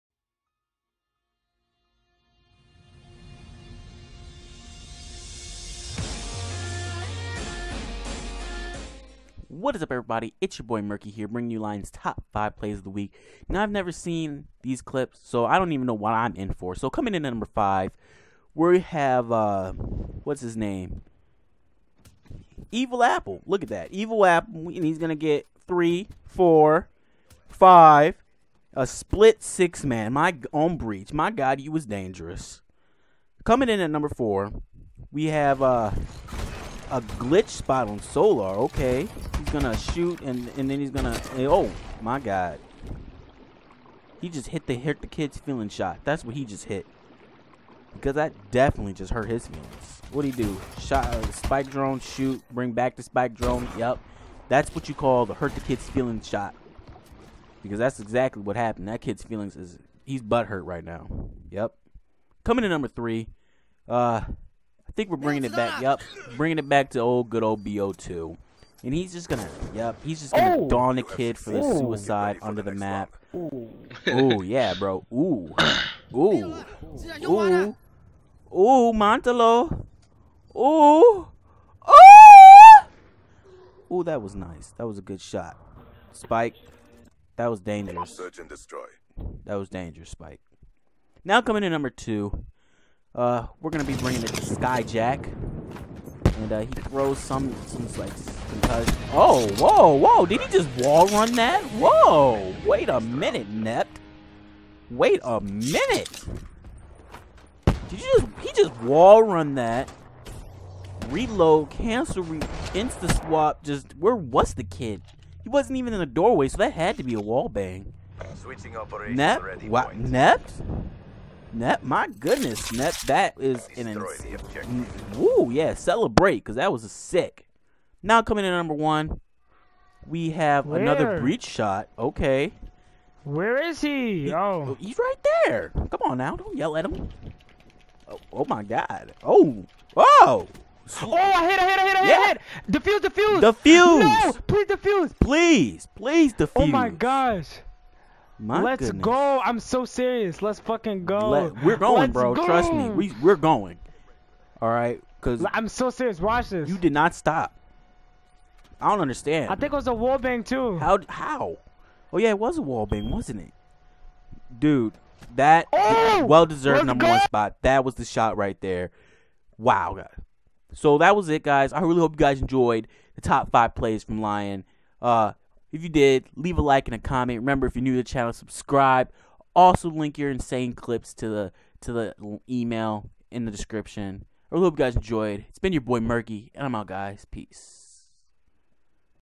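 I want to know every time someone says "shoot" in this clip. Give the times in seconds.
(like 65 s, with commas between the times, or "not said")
39 s, 51 s.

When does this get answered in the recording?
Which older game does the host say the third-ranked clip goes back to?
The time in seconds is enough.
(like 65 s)
67 s.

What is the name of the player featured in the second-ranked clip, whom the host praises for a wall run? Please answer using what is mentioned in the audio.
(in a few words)
Skyjack.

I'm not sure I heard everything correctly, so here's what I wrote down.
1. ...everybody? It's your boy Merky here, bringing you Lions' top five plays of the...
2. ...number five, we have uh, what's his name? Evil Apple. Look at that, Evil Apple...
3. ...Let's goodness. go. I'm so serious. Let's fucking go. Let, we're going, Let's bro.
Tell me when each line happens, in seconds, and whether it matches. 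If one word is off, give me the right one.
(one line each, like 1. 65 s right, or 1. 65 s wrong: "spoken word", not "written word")
1. 9 s right
2. 17 s right
3. 148 s right.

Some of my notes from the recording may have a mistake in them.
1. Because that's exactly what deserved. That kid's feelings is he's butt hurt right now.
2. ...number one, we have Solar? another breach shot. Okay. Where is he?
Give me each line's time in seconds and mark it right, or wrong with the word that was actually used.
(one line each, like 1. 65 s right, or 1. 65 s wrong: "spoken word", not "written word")
1. 57 s wrong: "happened", not "deserved"
2. 128 s wrong: "Where", not "Solar".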